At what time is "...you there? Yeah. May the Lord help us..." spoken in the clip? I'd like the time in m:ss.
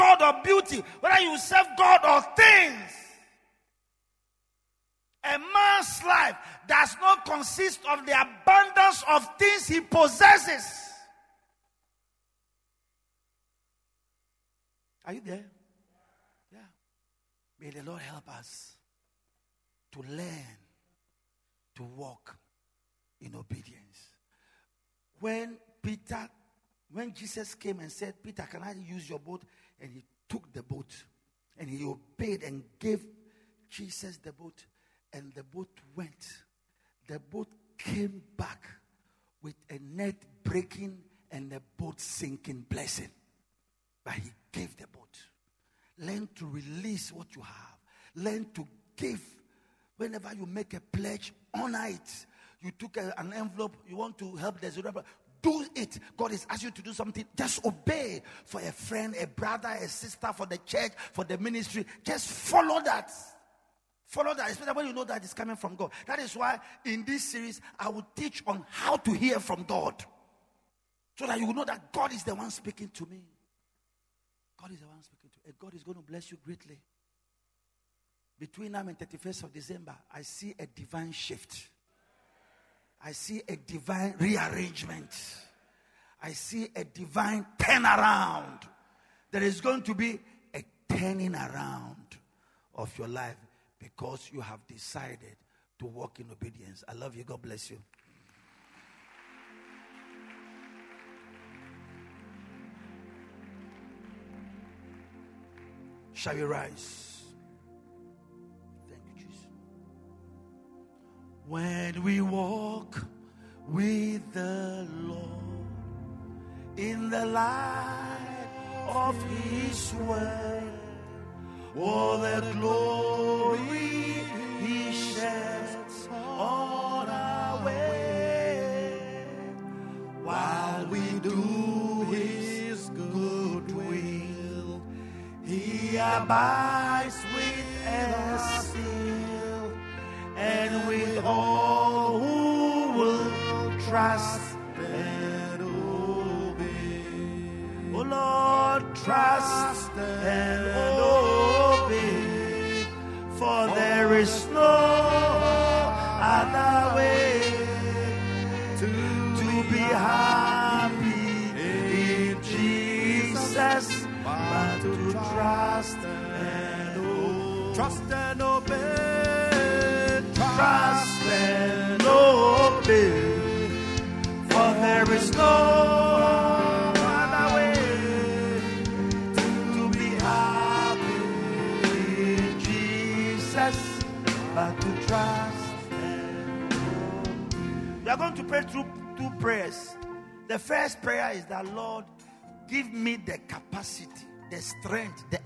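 0:15.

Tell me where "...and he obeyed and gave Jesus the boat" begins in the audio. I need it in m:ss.
0:31.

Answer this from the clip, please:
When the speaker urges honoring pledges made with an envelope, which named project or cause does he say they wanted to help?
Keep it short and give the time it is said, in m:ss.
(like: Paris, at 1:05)
Zerubbabel, at 0:54.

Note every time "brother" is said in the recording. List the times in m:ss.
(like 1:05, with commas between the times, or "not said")
0:59.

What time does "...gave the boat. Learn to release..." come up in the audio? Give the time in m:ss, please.
0:44.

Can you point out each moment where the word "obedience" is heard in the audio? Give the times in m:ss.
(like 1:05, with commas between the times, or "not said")
0:23, 1:36.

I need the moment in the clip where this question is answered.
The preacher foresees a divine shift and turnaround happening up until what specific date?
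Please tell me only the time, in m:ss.
1:18.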